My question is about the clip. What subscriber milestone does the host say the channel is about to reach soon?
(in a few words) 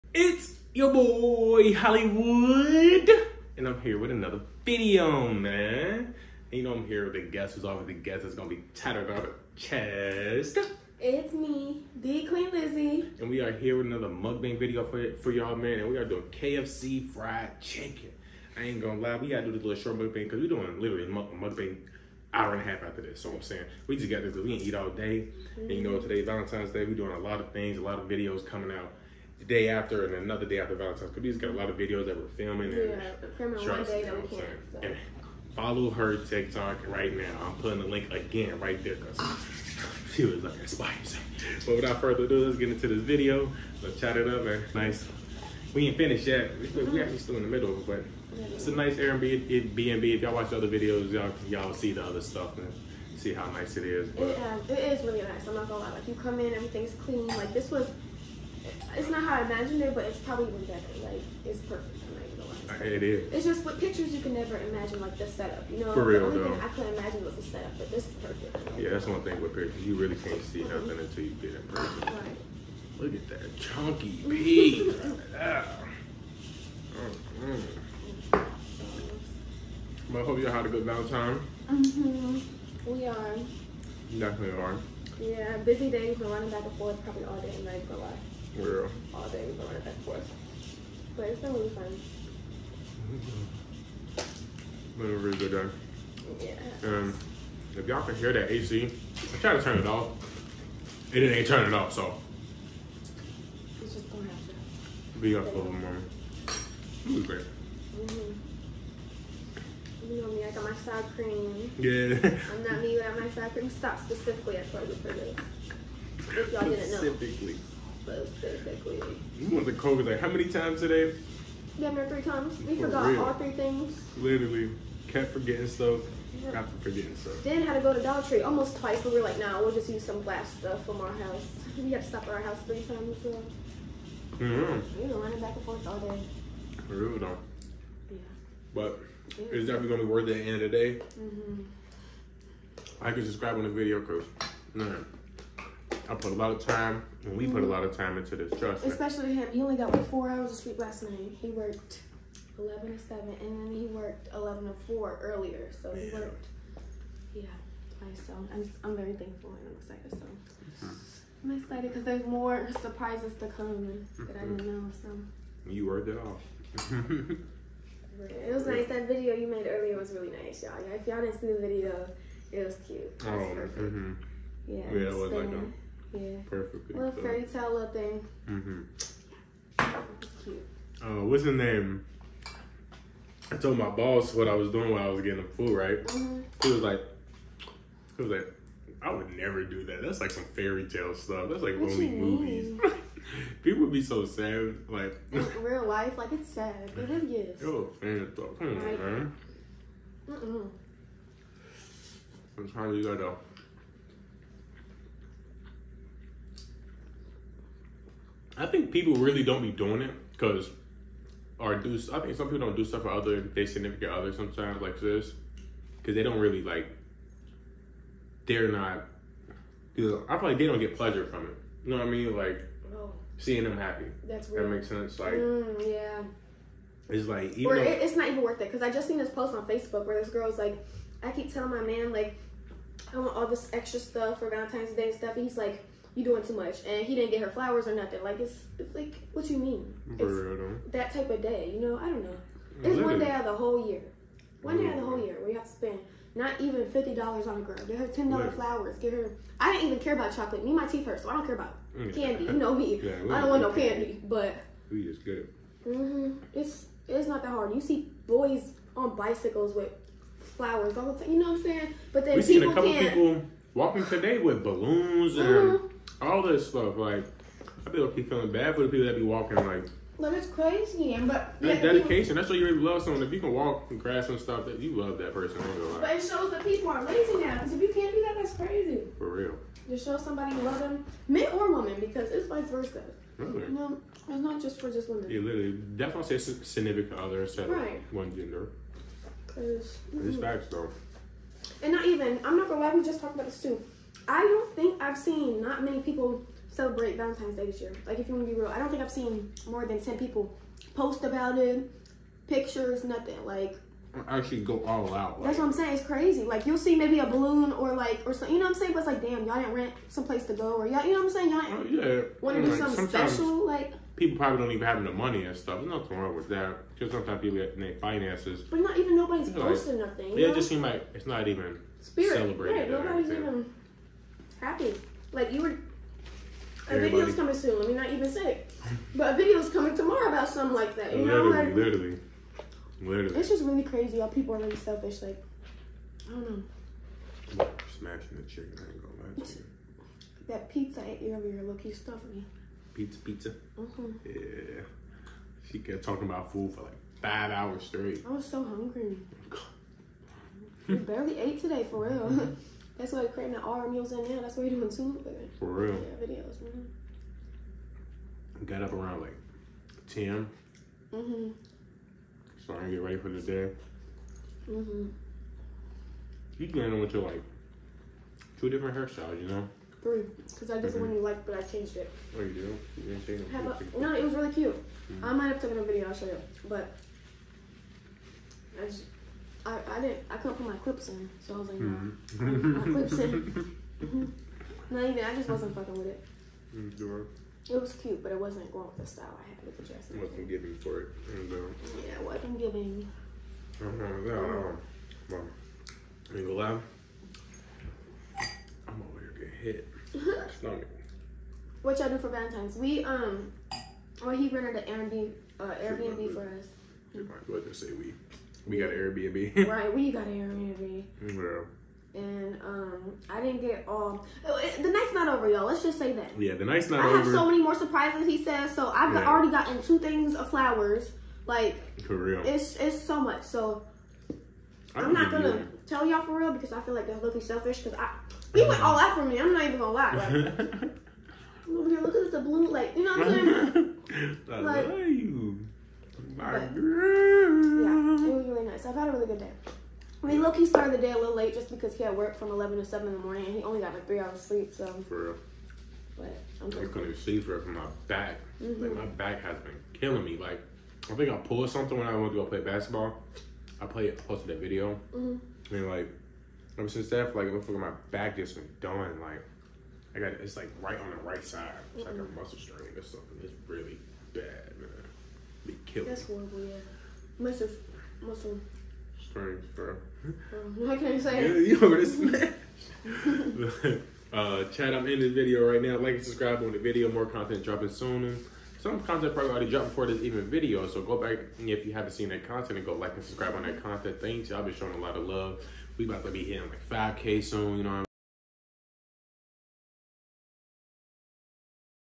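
5K.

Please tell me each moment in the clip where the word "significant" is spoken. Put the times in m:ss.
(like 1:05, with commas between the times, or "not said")
3:33, 4:46.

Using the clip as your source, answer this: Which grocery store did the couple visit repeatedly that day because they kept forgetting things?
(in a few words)
Kroger's.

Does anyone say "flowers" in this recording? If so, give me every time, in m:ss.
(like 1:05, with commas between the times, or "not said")
3:57, 4:08, 4:20, 7:00.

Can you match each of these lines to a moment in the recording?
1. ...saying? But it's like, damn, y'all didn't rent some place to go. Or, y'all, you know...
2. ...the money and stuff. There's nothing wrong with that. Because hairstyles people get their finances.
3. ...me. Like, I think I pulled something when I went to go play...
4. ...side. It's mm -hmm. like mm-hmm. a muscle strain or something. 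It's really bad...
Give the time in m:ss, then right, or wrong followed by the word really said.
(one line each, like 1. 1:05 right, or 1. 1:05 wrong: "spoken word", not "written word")
1. 5:08 right
2. 5:15 wrong: "sometimes", not "hairstyles"
3. 7:30 right
4. 7:41 right.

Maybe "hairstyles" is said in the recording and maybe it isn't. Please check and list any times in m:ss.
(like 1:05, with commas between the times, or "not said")
6:08.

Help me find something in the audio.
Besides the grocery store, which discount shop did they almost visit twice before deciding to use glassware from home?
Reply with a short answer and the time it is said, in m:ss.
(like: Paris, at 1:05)
Dollar Tree, at 2:08.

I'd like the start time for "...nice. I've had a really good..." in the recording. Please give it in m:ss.
7:18.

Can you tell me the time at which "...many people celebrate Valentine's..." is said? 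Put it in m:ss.
4:55.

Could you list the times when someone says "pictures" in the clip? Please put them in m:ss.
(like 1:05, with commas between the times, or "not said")
1:03, 1:09, 5:02.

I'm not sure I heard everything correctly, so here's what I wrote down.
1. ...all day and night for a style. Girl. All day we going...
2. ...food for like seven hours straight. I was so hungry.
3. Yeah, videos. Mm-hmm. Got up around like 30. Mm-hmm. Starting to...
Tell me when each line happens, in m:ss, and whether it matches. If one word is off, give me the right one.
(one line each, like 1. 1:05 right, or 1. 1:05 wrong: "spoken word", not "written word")
1. 1:27 wrong: "while", not "style"
2. 5:46 wrong: "five", not "seven"
3. 5:55 wrong: "10", not "30".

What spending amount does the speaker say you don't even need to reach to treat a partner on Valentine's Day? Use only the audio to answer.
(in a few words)
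$50.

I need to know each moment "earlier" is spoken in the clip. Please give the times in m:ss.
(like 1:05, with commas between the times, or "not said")
2:35, 2:49.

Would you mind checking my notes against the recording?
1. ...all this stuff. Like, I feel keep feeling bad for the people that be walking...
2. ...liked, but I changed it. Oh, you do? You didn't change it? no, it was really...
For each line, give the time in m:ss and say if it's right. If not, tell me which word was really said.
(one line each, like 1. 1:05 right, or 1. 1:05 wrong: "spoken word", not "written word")
1. 4:26 right
2. 6:11 right.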